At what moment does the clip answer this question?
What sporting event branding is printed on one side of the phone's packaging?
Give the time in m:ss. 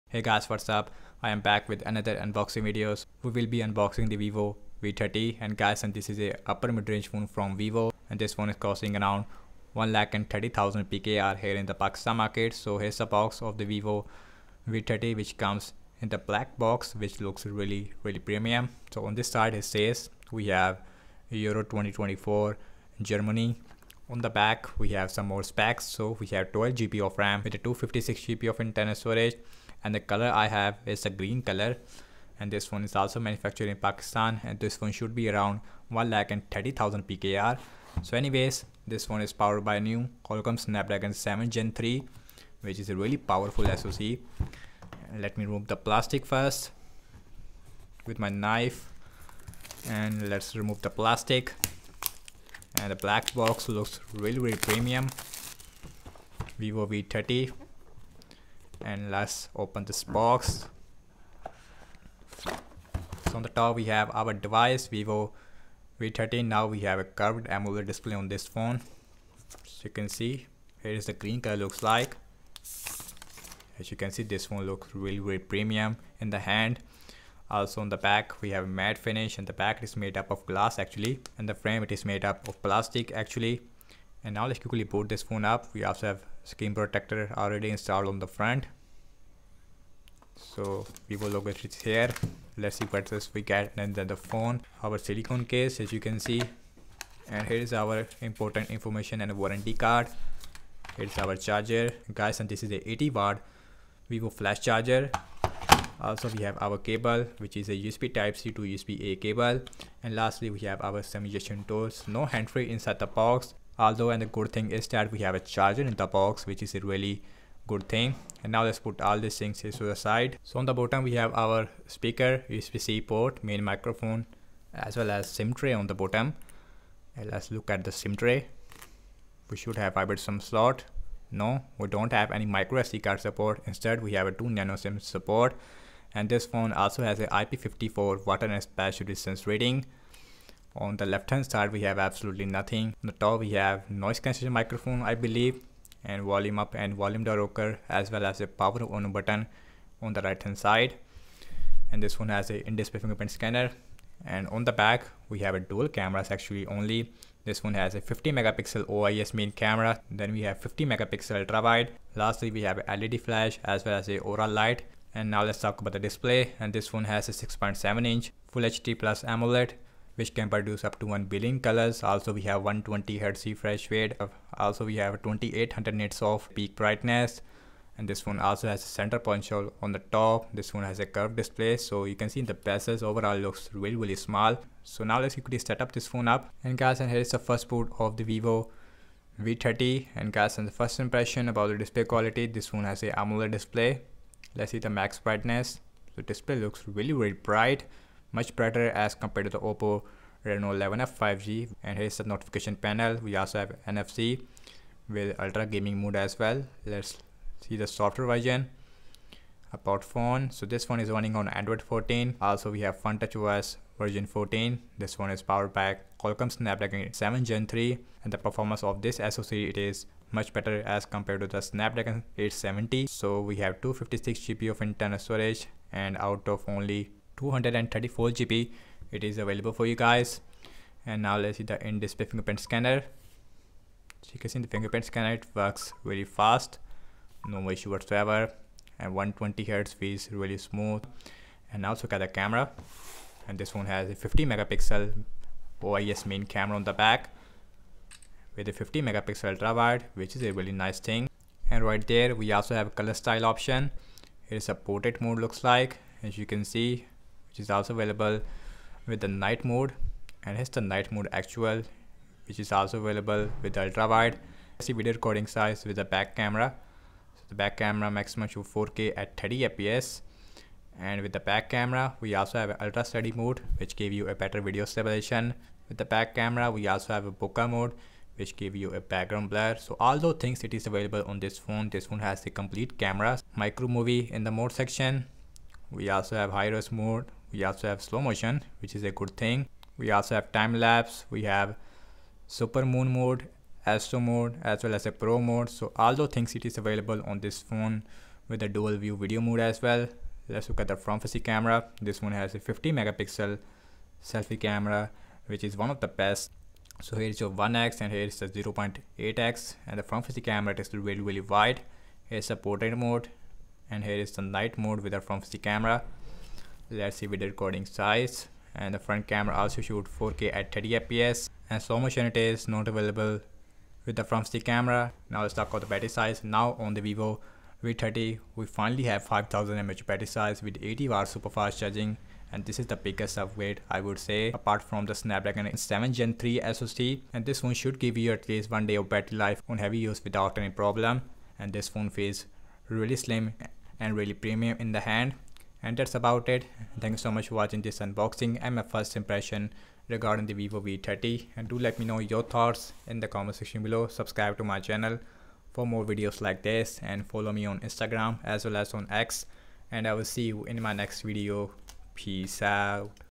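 0:21.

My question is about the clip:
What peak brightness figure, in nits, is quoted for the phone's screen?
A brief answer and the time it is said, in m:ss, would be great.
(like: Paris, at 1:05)
2800 nits, at 2:55.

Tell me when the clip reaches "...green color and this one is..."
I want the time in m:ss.
0:31.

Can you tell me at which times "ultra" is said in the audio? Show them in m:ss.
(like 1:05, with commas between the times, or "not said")
2:41, 3:25, 4:09, 4:23, 4:32.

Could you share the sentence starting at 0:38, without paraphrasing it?
So anyways, this one is powered by new Qualcomm Snapdragon 7 Gen 3 which is a really powerful SoC.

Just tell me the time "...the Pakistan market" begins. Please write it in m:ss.
0:11.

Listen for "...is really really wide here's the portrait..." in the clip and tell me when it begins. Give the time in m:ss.
5:10.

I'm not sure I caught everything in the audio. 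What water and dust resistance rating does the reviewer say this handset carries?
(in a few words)
IP54.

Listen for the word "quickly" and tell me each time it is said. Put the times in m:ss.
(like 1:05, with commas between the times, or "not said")
1:24, 3:05.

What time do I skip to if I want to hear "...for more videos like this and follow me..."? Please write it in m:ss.
5:55.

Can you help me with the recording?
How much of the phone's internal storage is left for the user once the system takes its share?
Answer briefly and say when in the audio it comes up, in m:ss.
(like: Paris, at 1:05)
234 GB, at 3:47.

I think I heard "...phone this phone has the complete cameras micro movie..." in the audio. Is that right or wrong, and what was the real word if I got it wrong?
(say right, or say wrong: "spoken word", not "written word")
right.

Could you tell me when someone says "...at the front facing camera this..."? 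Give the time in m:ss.
5:00.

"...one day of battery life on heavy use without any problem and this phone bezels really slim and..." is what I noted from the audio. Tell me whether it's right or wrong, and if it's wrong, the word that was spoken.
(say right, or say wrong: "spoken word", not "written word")
wrong: "feels", not "bezels".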